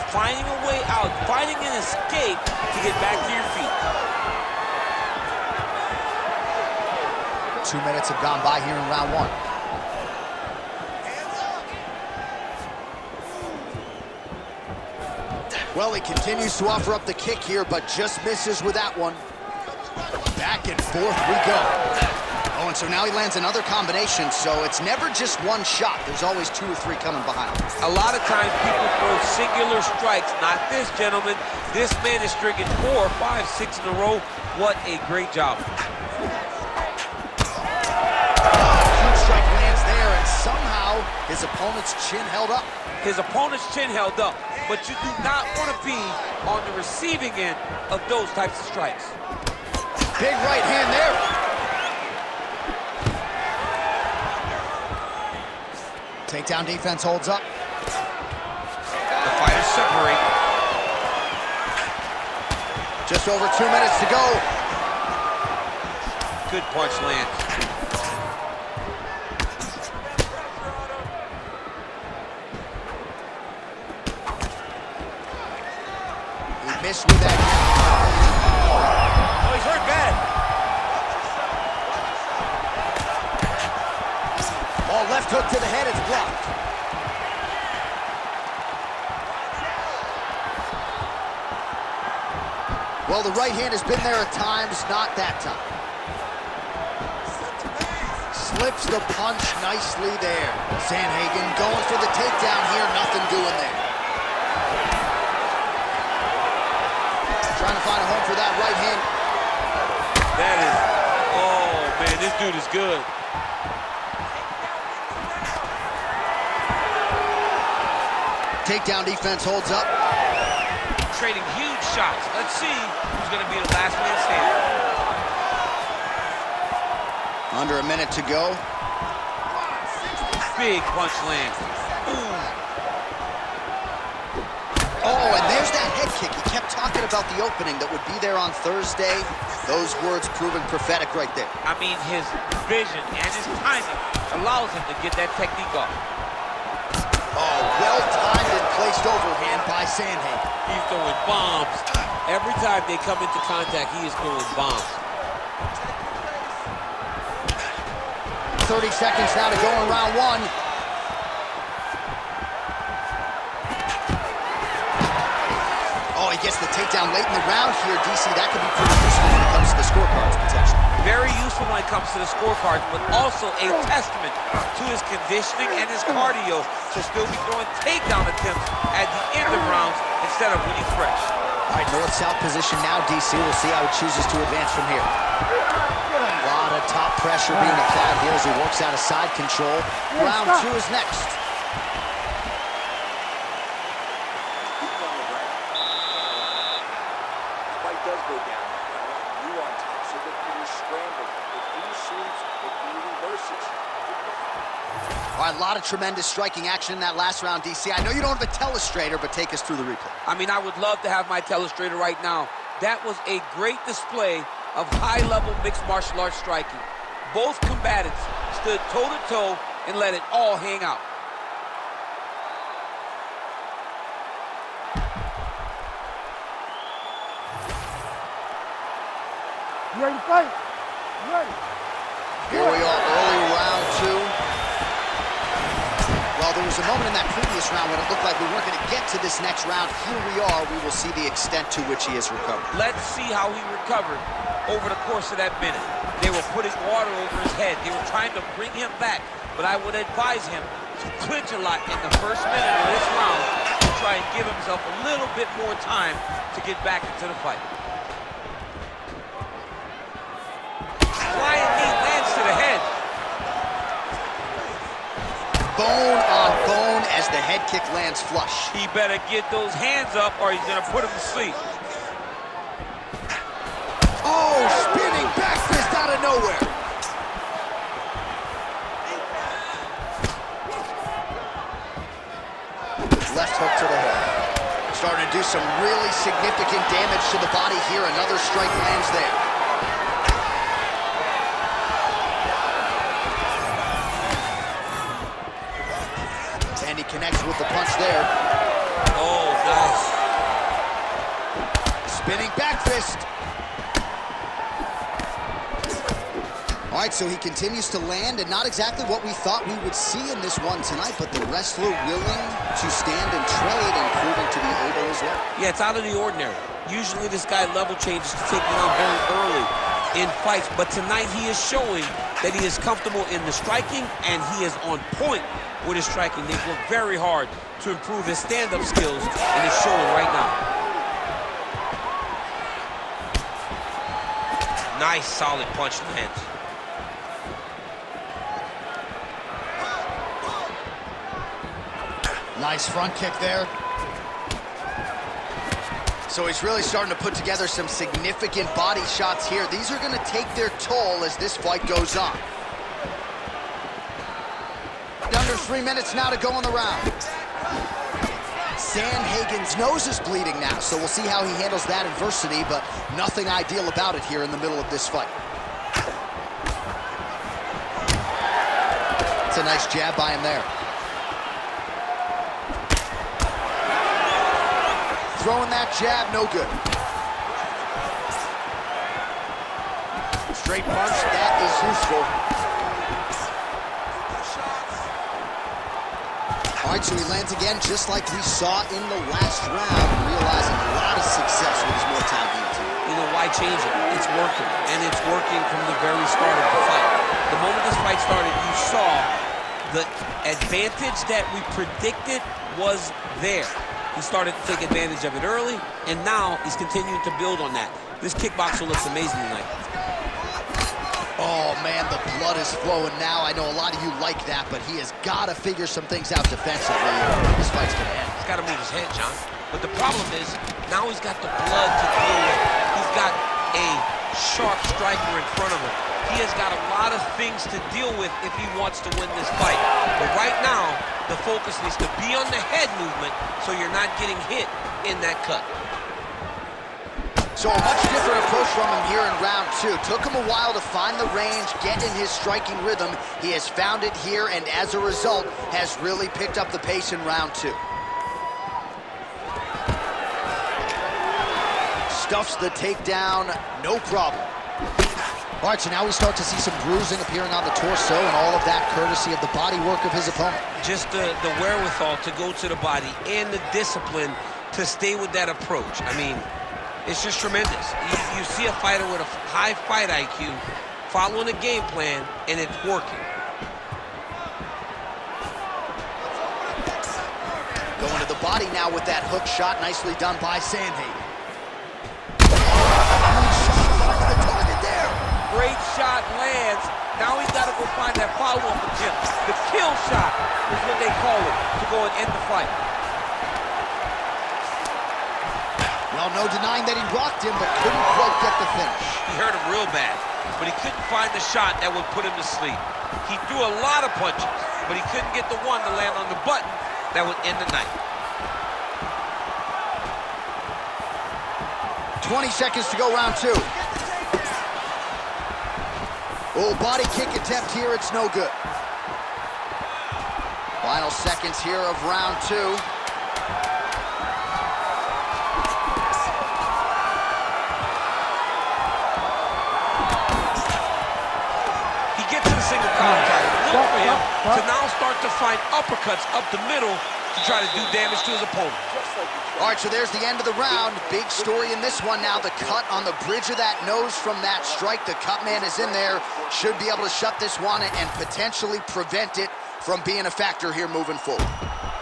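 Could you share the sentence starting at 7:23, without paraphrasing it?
He has found it here, and as a result, has really picked up the pace in round two.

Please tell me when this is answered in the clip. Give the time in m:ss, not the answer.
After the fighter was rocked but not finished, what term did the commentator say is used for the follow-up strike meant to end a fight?
8:09.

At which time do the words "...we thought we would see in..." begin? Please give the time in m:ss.
5:09.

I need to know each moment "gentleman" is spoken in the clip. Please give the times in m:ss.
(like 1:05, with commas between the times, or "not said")
0:30.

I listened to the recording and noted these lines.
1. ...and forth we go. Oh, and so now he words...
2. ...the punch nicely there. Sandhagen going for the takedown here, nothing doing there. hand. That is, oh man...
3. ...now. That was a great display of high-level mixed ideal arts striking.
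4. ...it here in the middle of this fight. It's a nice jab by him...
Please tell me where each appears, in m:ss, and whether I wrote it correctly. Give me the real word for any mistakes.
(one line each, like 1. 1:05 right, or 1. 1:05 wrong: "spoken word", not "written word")
1. 0:20 wrong: "lands", not "words"
2. 1:38 right
3. 3:32 wrong: "martial", not "ideal"
4. 6:04 right.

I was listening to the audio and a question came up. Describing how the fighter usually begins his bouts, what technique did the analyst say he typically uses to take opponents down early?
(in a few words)
Level changes.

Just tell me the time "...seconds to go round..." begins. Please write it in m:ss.
8:32.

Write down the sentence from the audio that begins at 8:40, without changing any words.
Final seconds here of round two.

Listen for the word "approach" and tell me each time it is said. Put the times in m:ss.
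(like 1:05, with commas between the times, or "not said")
7:18, 7:45.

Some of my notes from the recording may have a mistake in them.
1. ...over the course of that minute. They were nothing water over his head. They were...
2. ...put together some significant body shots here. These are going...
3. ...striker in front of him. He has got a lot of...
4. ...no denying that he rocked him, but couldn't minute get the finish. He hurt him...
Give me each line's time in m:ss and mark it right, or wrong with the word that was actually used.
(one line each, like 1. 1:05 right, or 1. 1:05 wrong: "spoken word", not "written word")
1. 4:04 wrong: "putting", not "nothing"
2. 5:47 right
3. 7:04 right
4. 8:16 wrong: "quite", not "minute".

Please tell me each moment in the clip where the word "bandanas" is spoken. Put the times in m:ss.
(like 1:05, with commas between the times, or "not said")
not said.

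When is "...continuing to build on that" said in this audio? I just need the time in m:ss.
6:46.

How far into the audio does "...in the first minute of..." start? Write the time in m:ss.
4:11.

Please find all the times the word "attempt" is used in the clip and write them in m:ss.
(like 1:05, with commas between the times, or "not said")
2:58, 8:08, 8:37.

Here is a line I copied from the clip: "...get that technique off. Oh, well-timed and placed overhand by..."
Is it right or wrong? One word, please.
right.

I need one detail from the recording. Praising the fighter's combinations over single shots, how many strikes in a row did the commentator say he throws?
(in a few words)
4, 5, 6.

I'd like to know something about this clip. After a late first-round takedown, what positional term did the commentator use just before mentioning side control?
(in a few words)
North-south.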